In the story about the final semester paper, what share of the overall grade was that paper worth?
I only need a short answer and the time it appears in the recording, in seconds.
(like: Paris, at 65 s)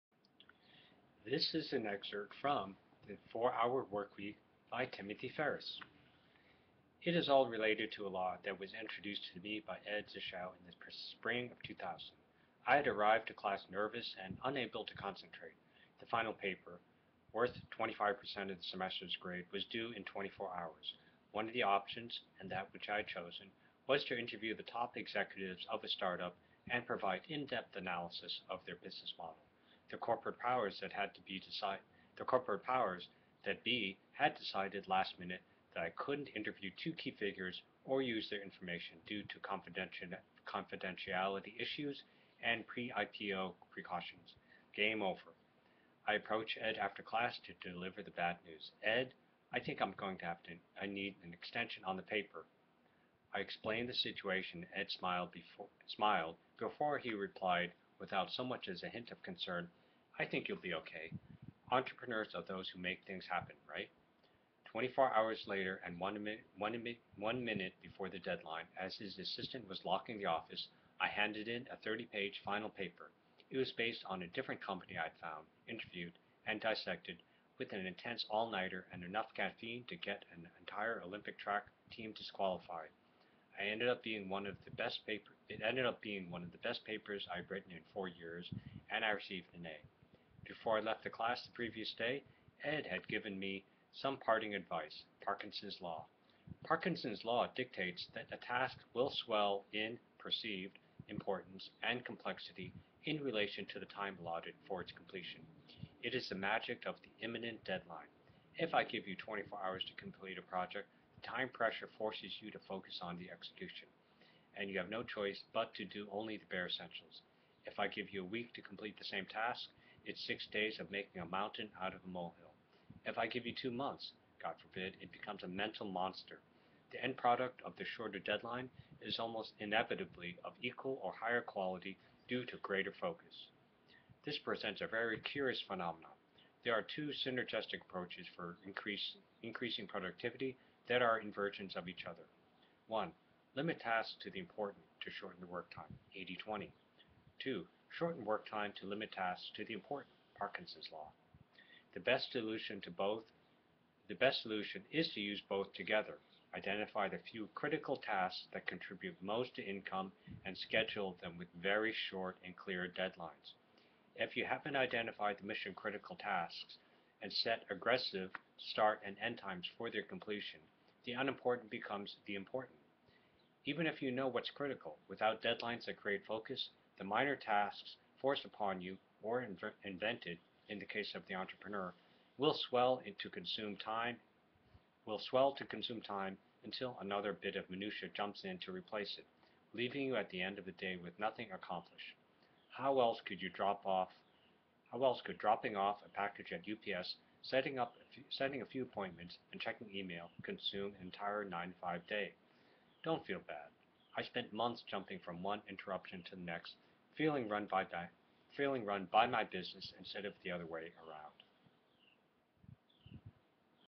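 25%, at 17 s.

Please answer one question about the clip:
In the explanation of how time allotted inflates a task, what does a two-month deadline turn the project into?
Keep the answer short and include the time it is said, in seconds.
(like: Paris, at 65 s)
a mental monster, at 125 s.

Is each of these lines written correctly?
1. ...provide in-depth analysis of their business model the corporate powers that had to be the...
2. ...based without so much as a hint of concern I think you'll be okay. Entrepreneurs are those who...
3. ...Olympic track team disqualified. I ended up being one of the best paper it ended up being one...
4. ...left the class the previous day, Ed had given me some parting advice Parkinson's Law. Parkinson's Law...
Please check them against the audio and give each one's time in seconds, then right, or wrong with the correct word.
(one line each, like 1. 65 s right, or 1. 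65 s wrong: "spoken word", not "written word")
1. 26 s right
2. 57 s wrong: "replied", not "based"
3. 81 s right
4. 90 s right.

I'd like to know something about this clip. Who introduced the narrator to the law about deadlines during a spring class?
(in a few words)
Ed Zschau.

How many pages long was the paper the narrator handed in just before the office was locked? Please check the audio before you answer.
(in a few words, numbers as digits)
30.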